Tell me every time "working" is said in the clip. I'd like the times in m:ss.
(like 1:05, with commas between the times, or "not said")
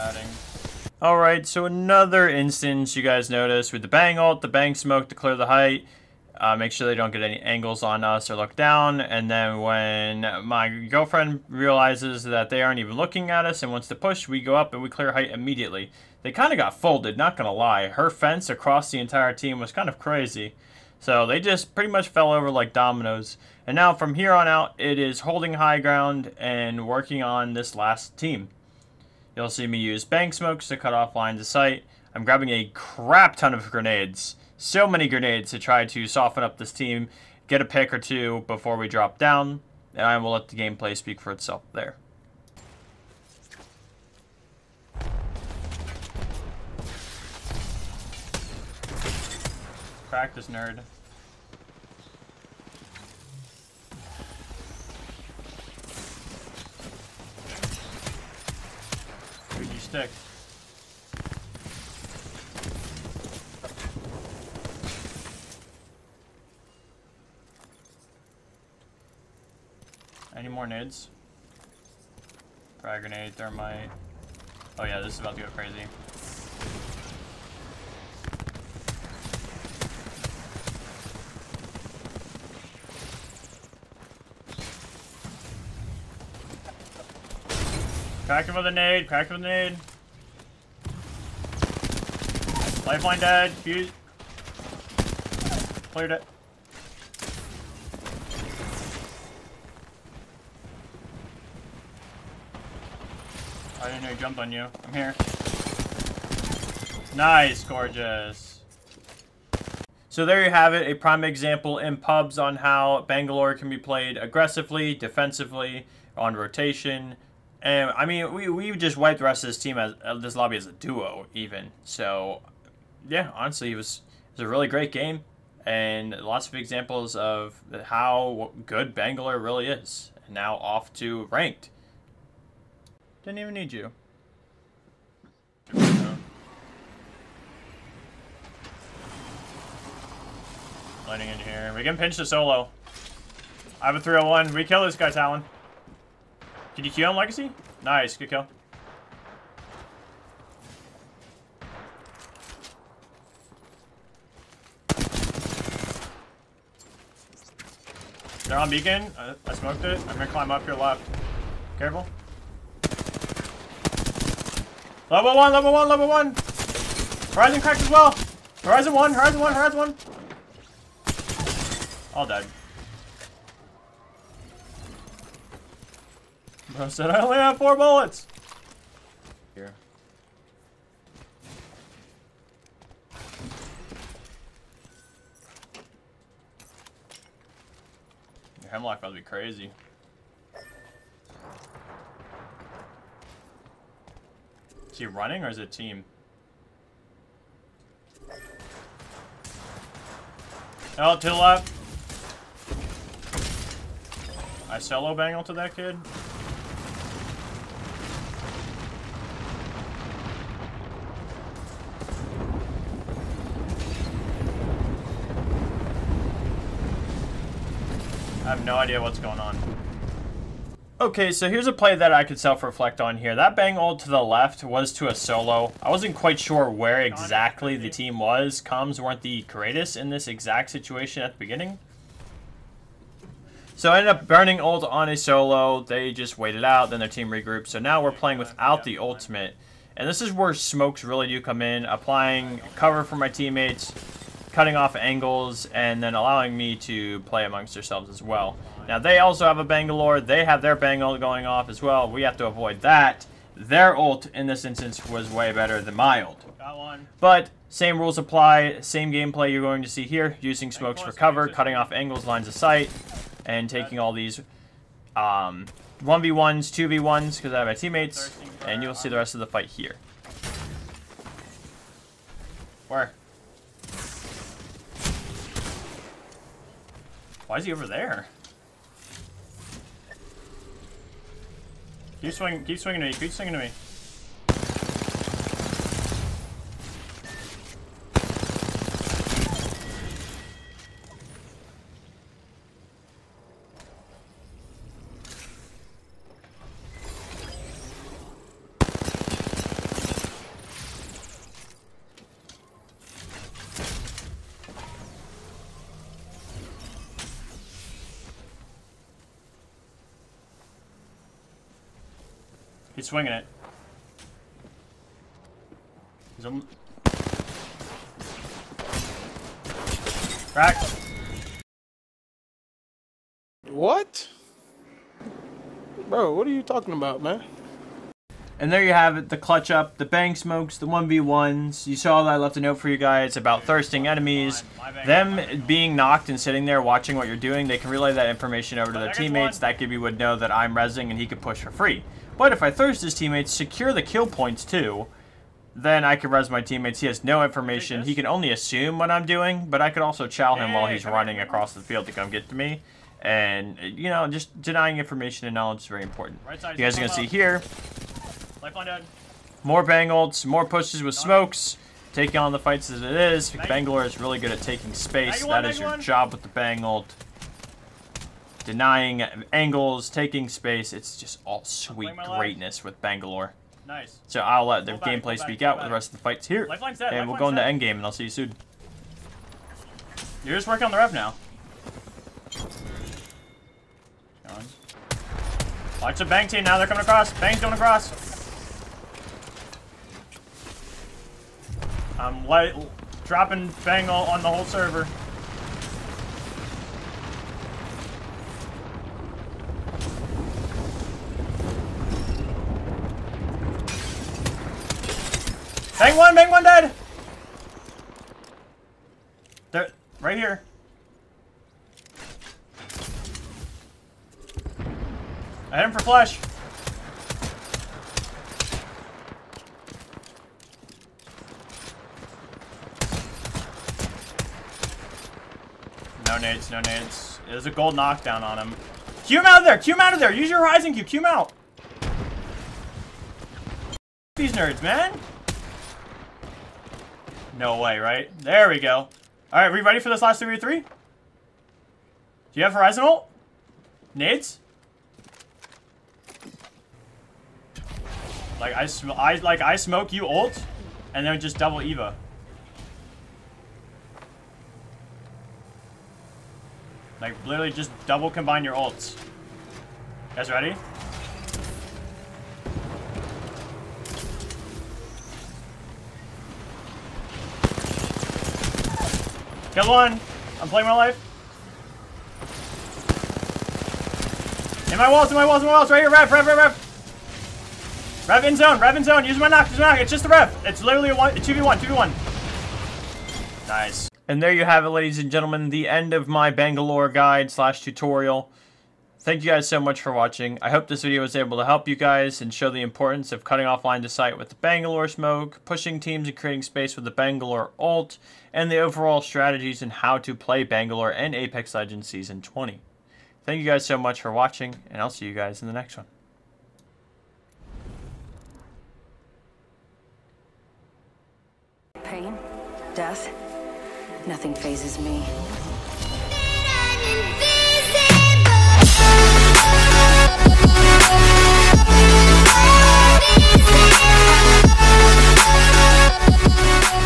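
0:26, 6:20.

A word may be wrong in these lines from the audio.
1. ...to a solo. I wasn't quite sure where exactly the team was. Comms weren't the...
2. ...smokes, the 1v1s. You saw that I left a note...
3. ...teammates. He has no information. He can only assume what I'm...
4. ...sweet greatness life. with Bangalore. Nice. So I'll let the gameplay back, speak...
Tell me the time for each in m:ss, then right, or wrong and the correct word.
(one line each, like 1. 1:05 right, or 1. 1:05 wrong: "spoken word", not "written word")
1. 3:44 right
2. 5:30 right
3. 5:46 right
4. 6:11 right.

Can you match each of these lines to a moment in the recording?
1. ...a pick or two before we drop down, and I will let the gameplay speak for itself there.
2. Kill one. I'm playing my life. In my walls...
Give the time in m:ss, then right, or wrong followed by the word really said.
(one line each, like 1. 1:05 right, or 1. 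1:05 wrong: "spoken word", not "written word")
1. 0:37 right
2. 7:49 right.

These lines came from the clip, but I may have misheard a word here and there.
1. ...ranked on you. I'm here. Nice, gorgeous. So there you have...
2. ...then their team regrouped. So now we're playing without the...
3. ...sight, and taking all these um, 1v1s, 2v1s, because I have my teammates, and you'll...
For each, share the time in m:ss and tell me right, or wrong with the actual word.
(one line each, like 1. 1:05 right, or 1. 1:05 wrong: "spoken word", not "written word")
1. 1:44 wrong: "jumped", not "ranked"
2. 3:56 right
3. 4:22 right.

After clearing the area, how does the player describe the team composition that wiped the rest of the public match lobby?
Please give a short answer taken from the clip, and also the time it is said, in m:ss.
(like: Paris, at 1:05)
A duo, at 2:00.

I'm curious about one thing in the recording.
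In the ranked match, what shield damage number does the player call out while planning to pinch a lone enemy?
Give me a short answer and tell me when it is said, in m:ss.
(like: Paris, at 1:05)
301, at 2:24.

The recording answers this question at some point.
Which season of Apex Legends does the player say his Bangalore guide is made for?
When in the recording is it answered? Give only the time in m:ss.
8:22.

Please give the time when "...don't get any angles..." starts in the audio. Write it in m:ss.
0:06.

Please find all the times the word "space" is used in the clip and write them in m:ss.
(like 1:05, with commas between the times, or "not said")
6:04, 6:10, 8:16.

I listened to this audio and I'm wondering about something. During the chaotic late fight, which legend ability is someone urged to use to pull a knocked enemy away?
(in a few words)
Horizon cube.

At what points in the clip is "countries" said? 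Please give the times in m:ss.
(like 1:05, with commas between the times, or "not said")
not said.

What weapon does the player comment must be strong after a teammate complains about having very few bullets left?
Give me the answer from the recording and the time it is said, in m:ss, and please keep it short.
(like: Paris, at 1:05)
Hemlok, at 3:08.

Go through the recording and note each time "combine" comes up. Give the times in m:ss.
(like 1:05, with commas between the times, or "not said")
7:38.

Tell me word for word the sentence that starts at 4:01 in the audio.
Applying cover for my teammates, cutting off angles and then allowing me to play amongst yourselves as well.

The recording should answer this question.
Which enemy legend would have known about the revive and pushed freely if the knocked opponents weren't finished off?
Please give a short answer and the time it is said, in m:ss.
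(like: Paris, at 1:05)
Gibby, at 5:39.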